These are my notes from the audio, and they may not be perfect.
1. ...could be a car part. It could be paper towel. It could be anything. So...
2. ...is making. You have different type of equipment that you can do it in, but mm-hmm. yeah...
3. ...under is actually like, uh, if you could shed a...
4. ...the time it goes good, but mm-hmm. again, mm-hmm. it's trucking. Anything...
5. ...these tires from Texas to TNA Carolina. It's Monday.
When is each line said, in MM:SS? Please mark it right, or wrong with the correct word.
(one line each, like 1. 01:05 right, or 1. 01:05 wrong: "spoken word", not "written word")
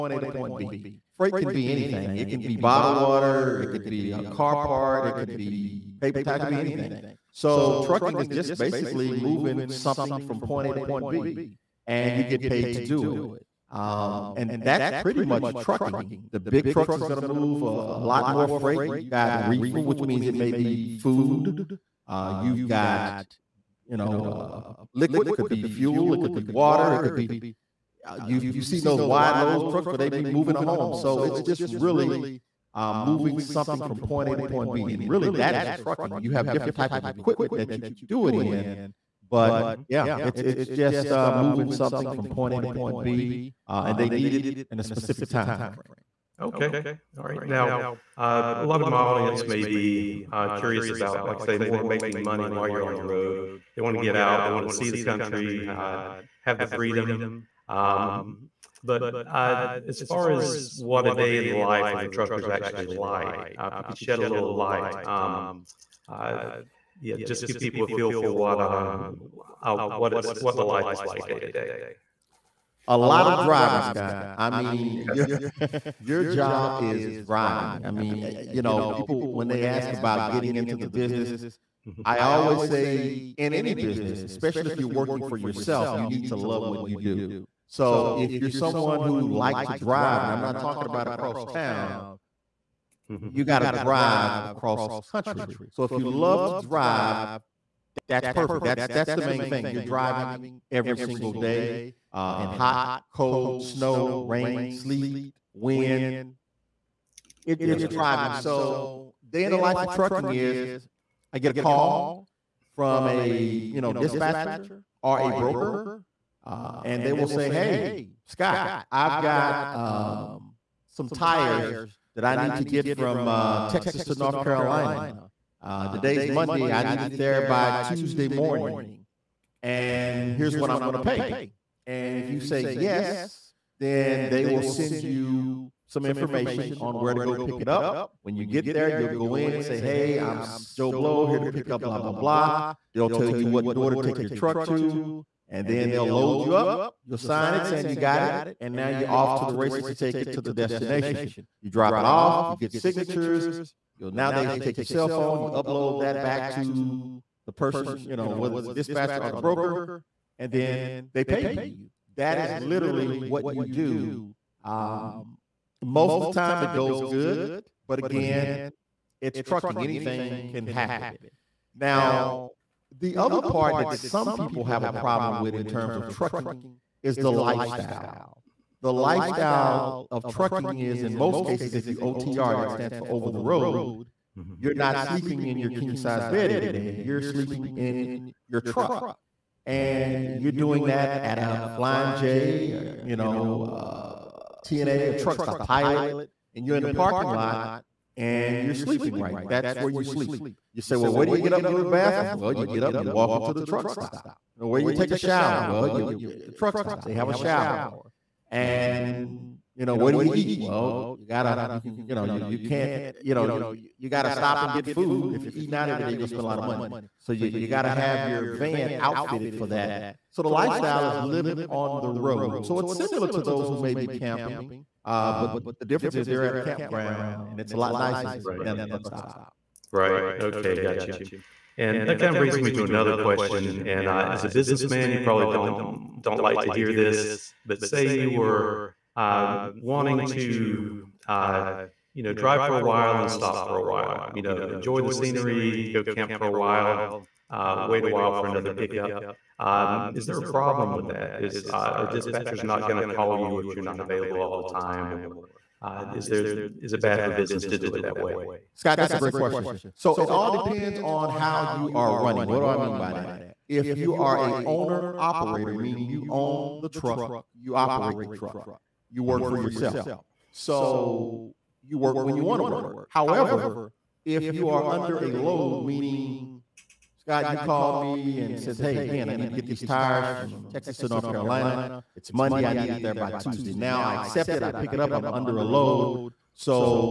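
1. 00:03 right
2. 00:35 wrong: "trucking", not "making"
3. 01:02 wrong: "trucker", not "under"
4. 02:46 right
5. 04:39 wrong: "North", not "TNA".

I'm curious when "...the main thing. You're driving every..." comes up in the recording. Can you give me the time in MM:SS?
01:39.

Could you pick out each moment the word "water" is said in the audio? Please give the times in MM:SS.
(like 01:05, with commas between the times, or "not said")
00:02, 00:26.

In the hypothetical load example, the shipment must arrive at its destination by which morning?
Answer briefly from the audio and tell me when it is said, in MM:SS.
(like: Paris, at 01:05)
Tuesday morning, at 02:07.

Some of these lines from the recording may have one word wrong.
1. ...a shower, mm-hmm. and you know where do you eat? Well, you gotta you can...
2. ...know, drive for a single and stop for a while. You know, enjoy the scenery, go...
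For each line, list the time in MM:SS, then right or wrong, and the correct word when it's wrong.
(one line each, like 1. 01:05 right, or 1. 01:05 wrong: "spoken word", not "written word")
1. 03:27 right
2. 04:02 wrong: "while", not "single".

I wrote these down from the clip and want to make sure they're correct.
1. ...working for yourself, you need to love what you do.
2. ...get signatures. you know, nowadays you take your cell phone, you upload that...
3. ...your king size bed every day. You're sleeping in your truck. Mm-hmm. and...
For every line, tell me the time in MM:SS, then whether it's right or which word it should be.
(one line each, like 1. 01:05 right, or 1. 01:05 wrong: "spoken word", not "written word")
1. 01:24 right
2. 02:32 right
3. 03:05 right.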